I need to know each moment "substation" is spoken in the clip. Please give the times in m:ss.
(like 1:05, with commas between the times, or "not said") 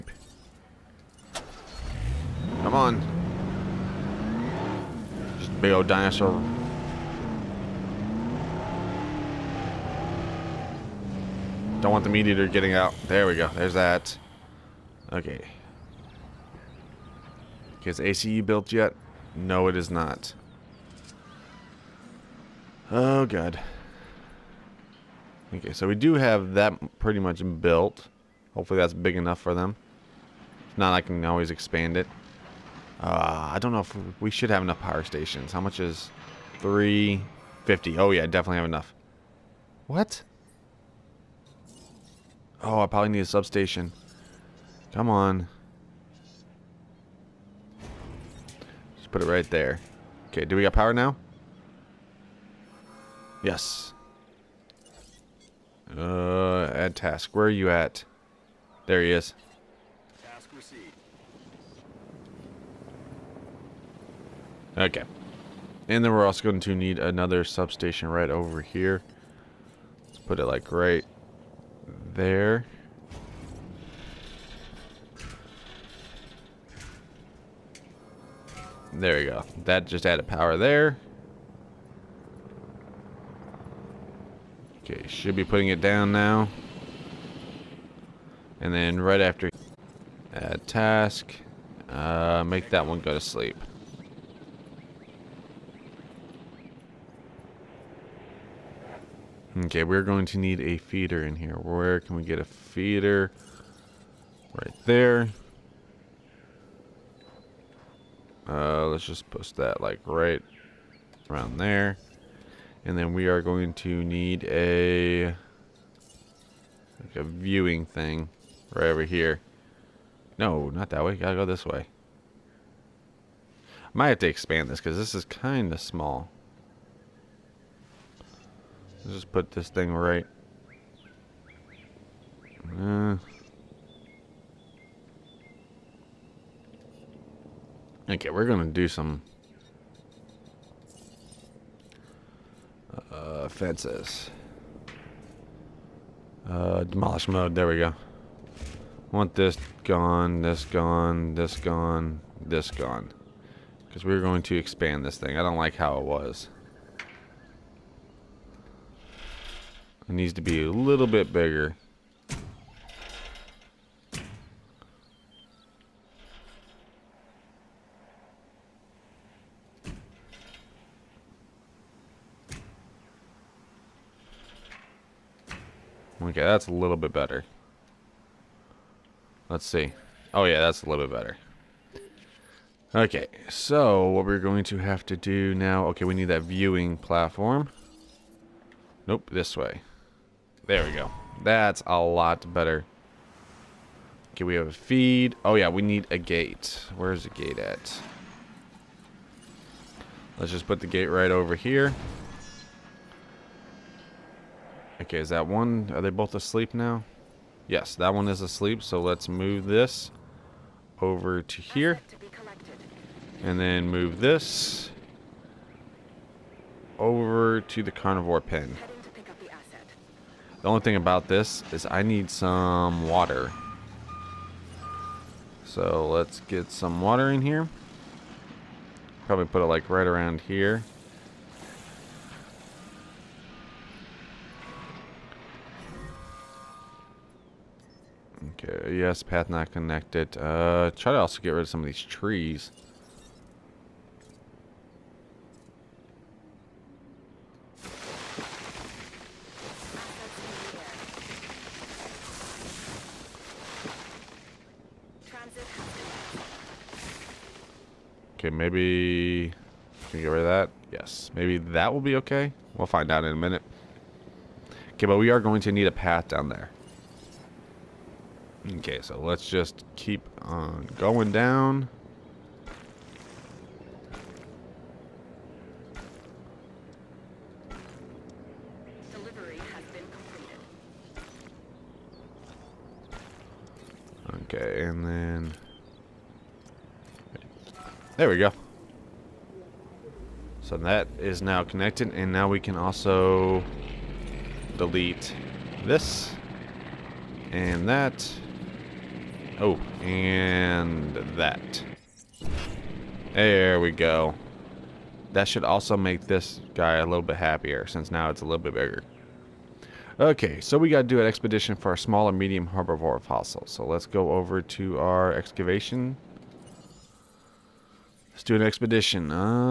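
0:43, 1:07.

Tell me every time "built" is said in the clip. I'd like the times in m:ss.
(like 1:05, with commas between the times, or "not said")
0:18, 0:27.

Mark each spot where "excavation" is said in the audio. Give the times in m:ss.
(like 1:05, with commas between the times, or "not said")
5:15.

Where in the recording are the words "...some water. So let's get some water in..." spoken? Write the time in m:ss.
3:42.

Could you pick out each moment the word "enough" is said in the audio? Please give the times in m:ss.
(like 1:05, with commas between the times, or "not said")
0:29, 0:34, 0:38.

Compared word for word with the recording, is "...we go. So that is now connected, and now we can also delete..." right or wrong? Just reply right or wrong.
right.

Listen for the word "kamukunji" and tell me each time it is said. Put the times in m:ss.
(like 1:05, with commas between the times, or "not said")
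not said.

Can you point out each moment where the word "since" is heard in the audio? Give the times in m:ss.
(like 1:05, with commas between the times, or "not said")
5:07.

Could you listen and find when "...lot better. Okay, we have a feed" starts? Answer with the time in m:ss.
3:11.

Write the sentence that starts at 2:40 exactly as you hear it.
It needs to be a little bit bigger.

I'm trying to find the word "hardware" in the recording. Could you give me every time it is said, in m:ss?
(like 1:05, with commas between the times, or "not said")
not said.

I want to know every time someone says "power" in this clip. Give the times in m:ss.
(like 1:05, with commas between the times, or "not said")
0:34, 0:50, 1:20.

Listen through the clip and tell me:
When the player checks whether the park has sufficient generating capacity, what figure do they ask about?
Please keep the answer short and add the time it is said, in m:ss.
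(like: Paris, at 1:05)
350, at 0:36.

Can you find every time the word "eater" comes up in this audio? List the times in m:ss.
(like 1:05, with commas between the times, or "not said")
0:12.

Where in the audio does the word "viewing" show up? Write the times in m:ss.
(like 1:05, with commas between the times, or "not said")
1:57, 3:06.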